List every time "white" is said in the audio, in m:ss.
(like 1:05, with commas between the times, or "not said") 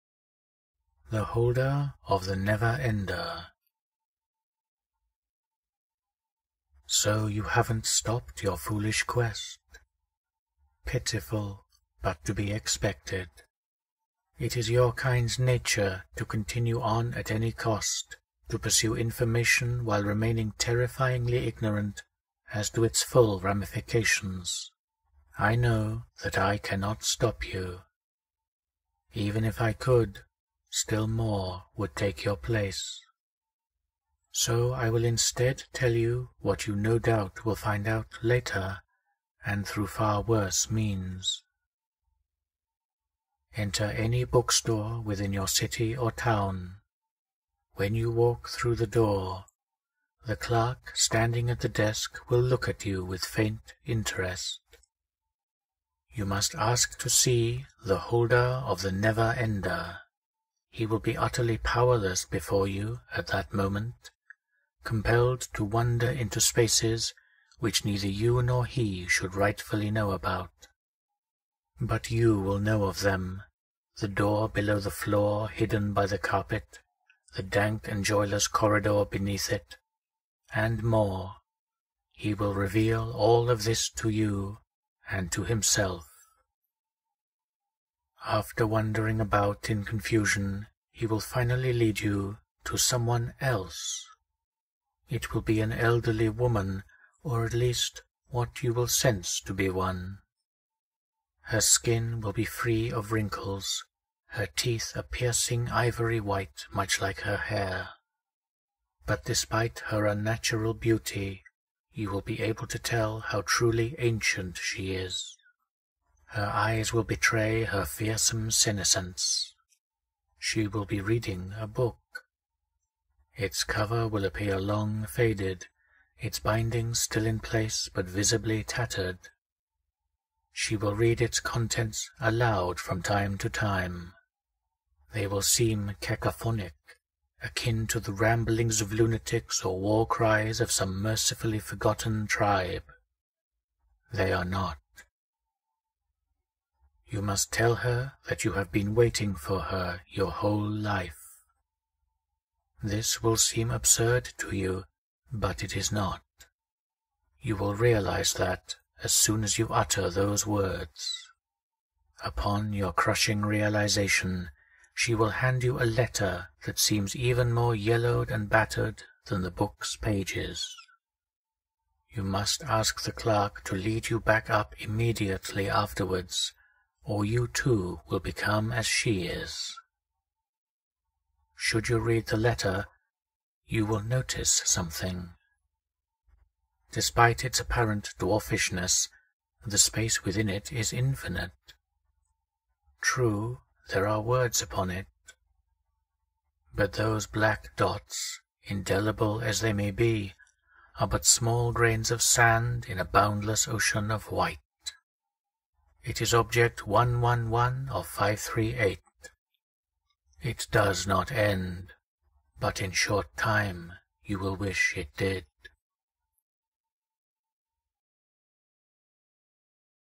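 1:46, 3:24.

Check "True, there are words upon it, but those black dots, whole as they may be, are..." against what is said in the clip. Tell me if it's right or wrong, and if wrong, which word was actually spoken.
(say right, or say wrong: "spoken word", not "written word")
wrong: "indelible", not "whole".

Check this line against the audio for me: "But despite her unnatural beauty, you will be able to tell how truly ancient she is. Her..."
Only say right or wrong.
right.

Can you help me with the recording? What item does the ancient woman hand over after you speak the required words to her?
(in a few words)
A letter.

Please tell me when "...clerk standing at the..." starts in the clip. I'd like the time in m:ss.
0:50.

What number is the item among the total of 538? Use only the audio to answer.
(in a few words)
111.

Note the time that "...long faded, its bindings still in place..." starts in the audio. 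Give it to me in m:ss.
2:04.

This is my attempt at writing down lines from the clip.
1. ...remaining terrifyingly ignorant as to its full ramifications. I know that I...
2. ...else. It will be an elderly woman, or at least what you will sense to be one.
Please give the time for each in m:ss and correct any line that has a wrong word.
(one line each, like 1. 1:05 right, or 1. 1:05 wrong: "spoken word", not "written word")
1. 0:20 right
2. 1:33 right.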